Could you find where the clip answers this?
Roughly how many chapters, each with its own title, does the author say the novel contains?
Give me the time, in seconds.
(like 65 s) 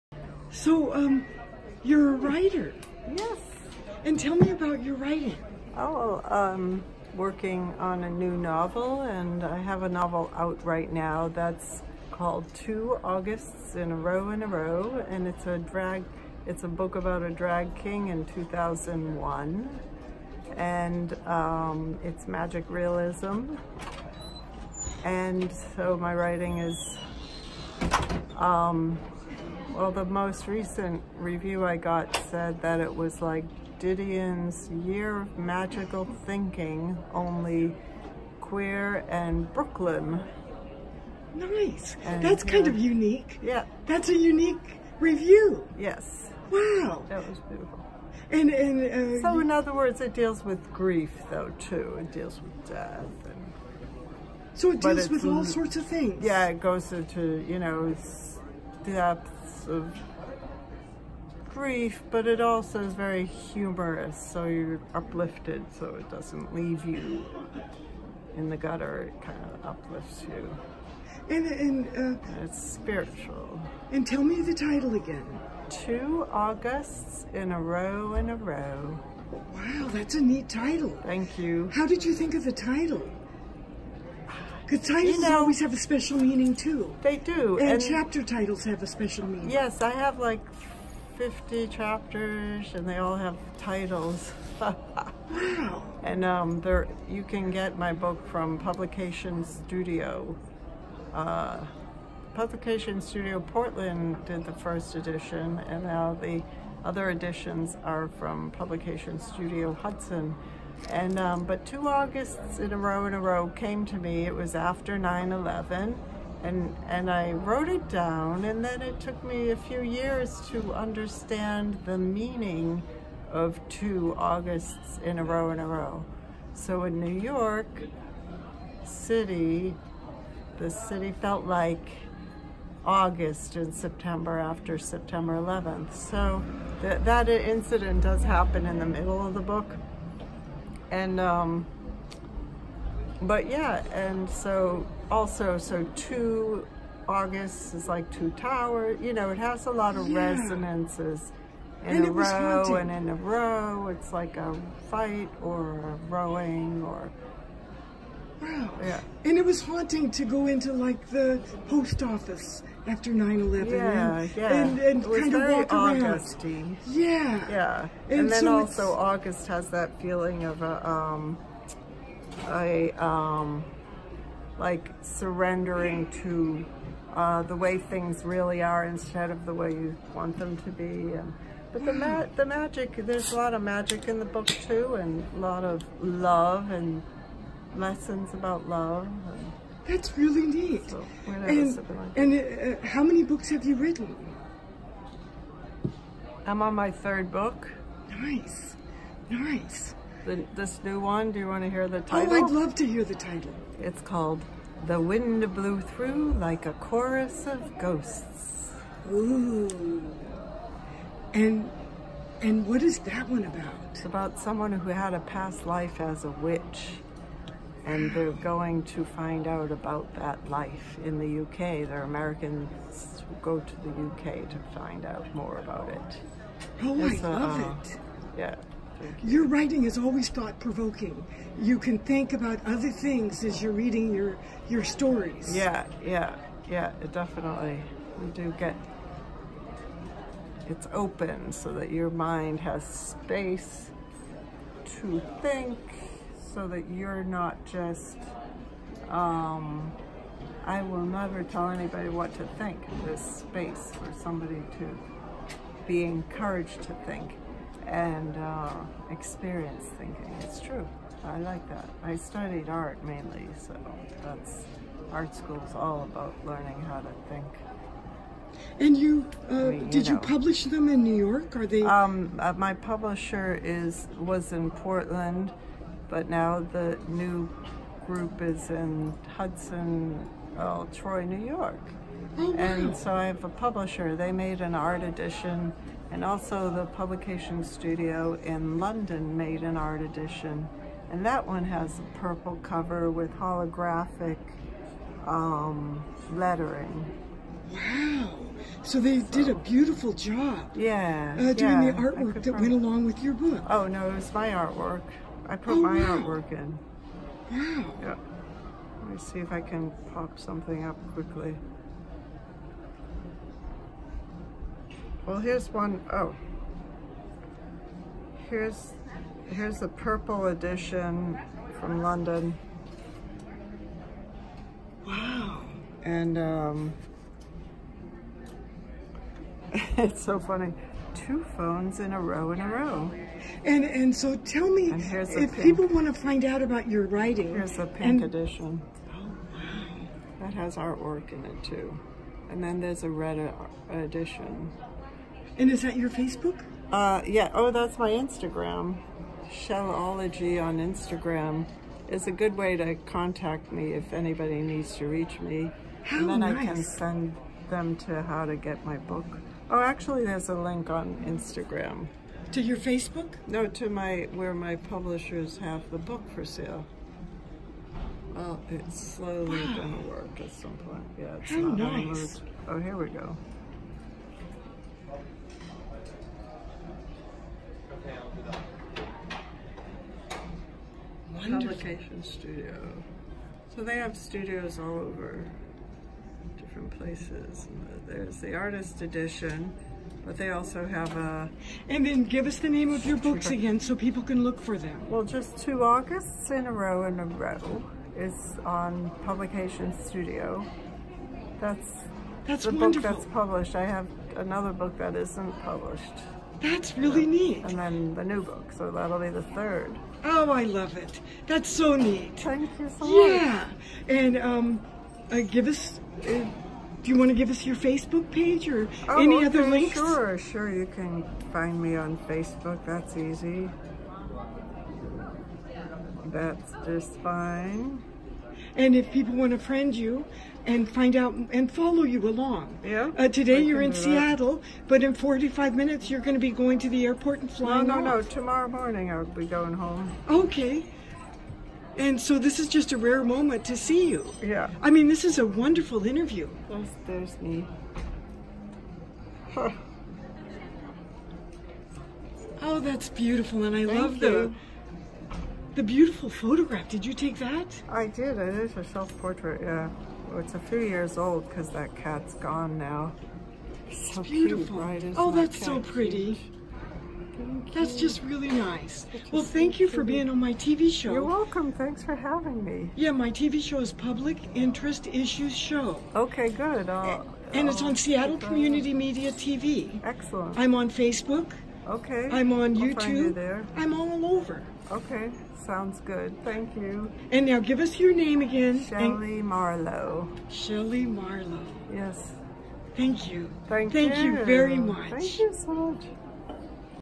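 91 s.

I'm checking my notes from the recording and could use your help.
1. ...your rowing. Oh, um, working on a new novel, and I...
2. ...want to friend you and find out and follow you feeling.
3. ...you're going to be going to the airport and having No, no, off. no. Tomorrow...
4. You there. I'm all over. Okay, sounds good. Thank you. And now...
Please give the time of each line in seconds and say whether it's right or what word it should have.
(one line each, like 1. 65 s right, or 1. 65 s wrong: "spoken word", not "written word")
1. 4 s wrong: "writing", not "rowing"
2. 429 s wrong: "along", not "feeling"
3. 436 s wrong: "flying", not "having"
4. 483 s right.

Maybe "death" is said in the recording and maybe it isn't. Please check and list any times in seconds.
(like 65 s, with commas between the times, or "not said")
52 s.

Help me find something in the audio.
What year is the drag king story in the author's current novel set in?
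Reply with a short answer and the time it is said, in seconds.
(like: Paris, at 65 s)
2001, at 18 s.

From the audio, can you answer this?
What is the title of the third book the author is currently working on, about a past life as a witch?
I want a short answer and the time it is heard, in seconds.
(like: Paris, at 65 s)
The Wind Blew Through Like a Chorus of Ghosts, at 204 s.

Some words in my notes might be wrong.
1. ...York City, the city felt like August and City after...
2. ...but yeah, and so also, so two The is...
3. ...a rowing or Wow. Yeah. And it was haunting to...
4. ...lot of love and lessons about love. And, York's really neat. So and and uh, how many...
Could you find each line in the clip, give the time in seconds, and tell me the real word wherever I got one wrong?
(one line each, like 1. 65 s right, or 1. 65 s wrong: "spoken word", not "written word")
1. 127 s wrong: "September", not "City"
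2. 143 s wrong: "August", not "The"
3. 155 s right
4. 185 s wrong: "That", not "York".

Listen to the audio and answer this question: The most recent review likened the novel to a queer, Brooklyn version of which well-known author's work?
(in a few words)
Didion.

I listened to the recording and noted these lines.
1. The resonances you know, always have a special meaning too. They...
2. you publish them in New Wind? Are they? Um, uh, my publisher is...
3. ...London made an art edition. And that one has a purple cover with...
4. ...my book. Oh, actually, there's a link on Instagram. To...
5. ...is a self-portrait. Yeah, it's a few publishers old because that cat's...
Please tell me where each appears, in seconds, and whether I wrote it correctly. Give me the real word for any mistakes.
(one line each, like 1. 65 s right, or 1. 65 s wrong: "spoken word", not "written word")
1. 84 s wrong: "titles", not "resonances"
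2. 270 s wrong: "York", not "Wind"
3. 288 s right
4. 358 s right
5. 458 s wrong: "years", not "publishers".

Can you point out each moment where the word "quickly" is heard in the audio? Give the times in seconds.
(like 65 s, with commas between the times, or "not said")
311 s.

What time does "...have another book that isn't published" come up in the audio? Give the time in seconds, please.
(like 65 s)
403 s.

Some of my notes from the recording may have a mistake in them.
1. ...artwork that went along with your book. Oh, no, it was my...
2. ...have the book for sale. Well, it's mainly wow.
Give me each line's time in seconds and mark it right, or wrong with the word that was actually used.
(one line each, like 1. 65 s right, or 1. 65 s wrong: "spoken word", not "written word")
1. 302 s right
2. 365 s wrong: "slowly", not "mainly".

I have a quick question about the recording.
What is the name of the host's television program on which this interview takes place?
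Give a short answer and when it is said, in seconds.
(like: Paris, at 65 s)
Public Interest Issues Show, at 473 s.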